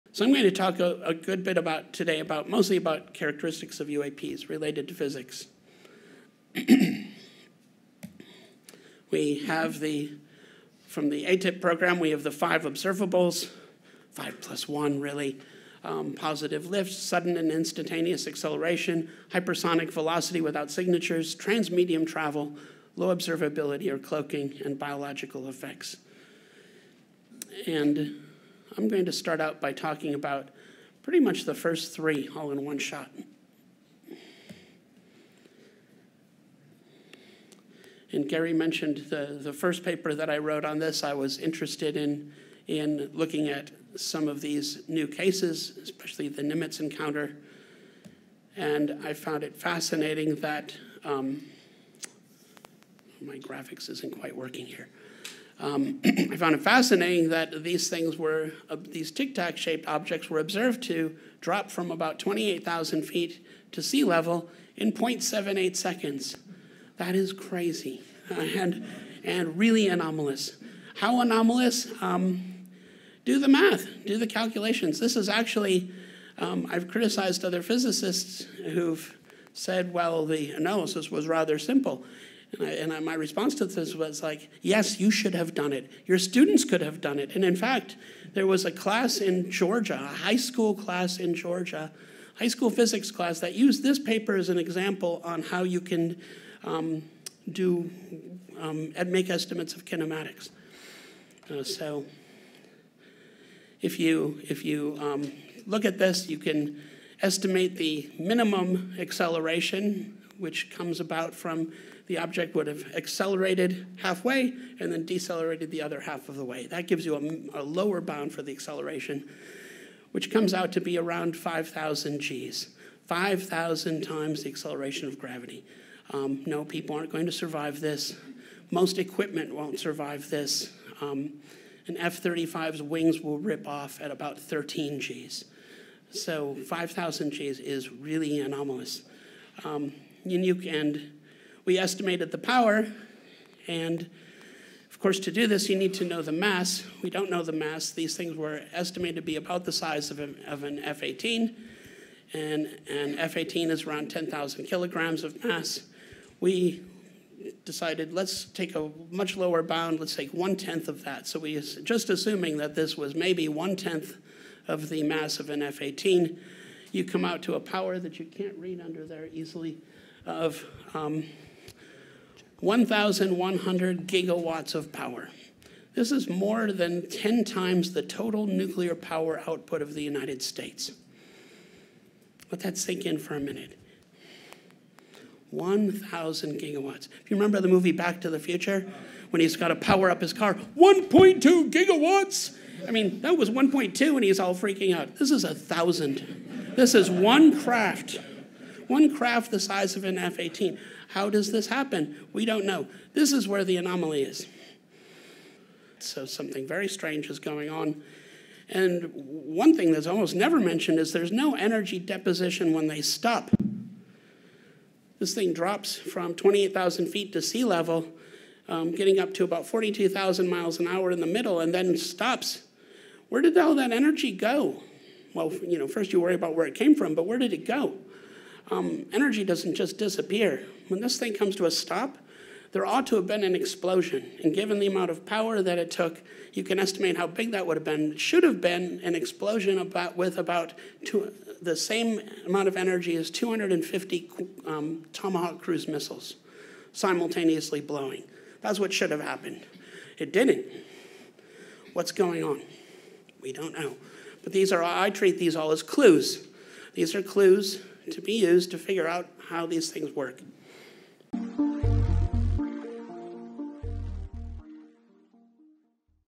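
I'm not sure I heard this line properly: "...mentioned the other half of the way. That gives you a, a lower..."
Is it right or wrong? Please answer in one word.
wrong.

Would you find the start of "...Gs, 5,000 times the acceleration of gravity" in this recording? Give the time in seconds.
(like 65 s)
122 s.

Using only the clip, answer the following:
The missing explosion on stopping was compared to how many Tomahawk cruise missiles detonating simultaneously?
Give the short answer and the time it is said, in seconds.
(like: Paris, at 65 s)
250, at 243 s.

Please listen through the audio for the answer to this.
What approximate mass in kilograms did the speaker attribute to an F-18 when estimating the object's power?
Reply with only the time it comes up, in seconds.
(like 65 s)
154 s.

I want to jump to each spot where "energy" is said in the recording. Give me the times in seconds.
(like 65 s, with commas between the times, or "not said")
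211 s, 223 s, 229 s, 242 s.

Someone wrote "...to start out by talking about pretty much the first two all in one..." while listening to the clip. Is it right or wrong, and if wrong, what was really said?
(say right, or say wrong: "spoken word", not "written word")
wrong: "three", not "two".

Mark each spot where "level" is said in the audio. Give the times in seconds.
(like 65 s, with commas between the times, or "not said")
64 s, 217 s.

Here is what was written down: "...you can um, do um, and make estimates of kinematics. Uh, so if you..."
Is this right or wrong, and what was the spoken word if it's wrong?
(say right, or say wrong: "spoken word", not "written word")
right.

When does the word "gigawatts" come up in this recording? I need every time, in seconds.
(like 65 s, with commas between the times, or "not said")
174 s, 186 s, 191 s.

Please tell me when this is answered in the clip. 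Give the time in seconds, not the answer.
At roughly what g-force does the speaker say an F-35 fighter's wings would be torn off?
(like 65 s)
134 s.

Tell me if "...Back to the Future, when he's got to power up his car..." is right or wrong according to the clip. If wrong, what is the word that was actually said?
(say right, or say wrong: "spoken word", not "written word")
right.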